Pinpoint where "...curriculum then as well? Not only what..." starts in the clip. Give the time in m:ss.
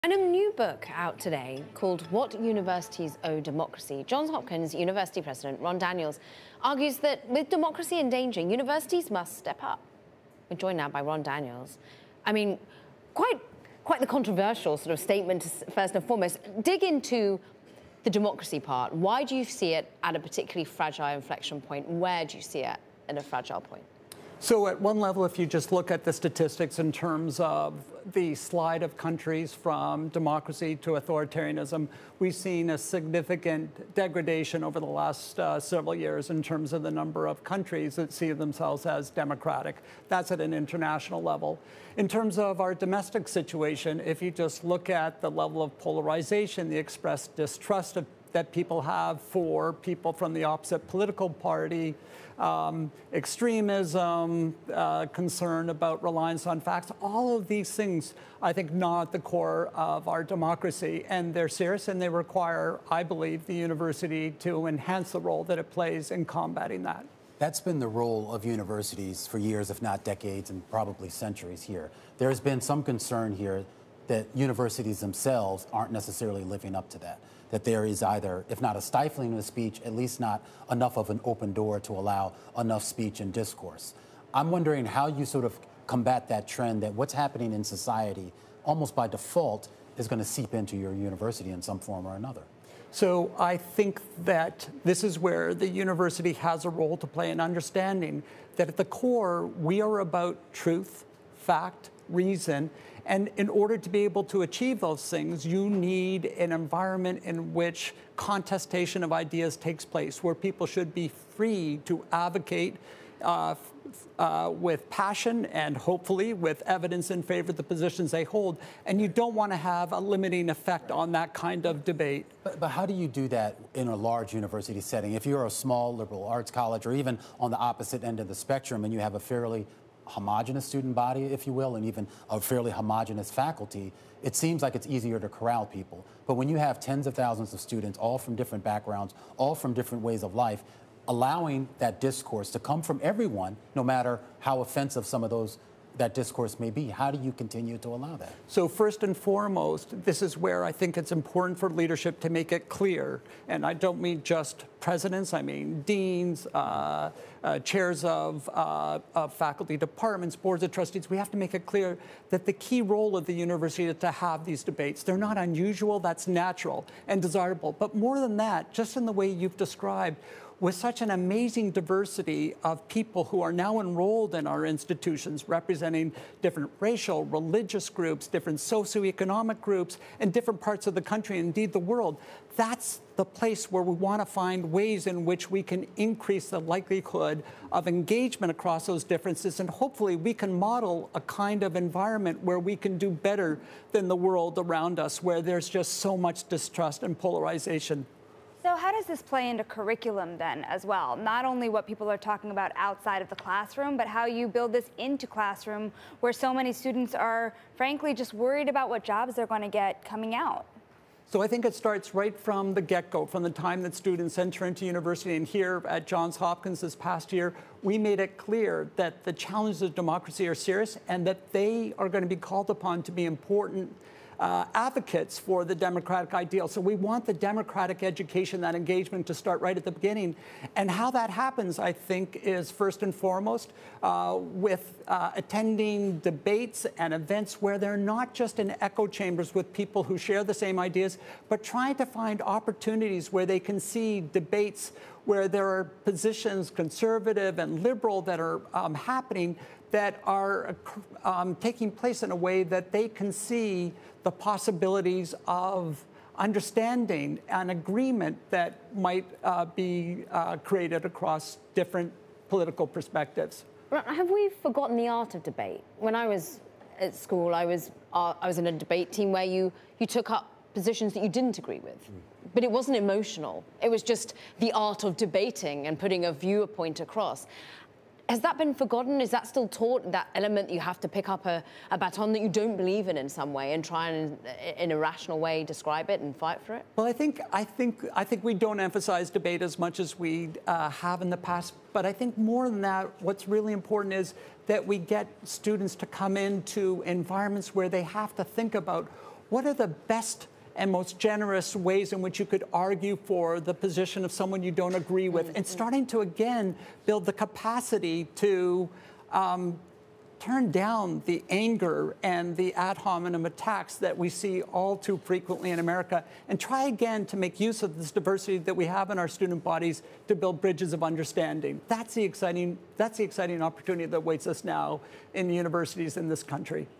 3:19.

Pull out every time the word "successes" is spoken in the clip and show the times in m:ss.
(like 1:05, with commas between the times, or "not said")
not said.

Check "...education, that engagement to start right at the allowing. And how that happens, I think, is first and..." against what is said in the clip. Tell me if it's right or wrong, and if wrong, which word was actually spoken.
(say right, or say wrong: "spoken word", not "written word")
wrong: "beginning", not "allowing".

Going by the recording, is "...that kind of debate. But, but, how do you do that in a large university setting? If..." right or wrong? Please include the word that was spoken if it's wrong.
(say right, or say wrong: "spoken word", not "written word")
right.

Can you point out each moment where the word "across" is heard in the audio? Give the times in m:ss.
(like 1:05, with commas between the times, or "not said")
3:08, 4:21, 4:36.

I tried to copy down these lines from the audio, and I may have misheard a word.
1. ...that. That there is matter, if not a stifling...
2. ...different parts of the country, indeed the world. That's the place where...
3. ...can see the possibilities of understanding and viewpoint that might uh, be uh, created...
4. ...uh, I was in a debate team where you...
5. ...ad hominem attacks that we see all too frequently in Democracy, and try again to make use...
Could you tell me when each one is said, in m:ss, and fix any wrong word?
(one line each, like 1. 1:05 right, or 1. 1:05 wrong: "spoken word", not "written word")
1. 1:16 wrong: "either", not "matter"
2. 3:00 right
3. 4:13 wrong: "agreement", not "viewpoint"
4. 4:28 right
5. 5:12 wrong: "America", not "Democracy".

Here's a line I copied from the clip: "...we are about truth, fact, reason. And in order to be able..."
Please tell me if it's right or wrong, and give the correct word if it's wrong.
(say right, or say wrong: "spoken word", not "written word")
right.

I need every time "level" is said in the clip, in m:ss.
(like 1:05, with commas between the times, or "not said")
0:24, 0:41, 0:45.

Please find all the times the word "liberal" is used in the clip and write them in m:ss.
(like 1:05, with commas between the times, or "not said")
2:05, 4:07.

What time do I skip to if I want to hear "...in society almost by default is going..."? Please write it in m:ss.
1:27.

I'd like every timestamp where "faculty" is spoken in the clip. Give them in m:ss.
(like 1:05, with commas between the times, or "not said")
2:13, 2:39.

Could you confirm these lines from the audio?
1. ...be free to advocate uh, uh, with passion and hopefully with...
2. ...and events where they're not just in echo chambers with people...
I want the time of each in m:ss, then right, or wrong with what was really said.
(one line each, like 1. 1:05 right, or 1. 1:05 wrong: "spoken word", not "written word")
1. 1:50 right
2. 3:56 right.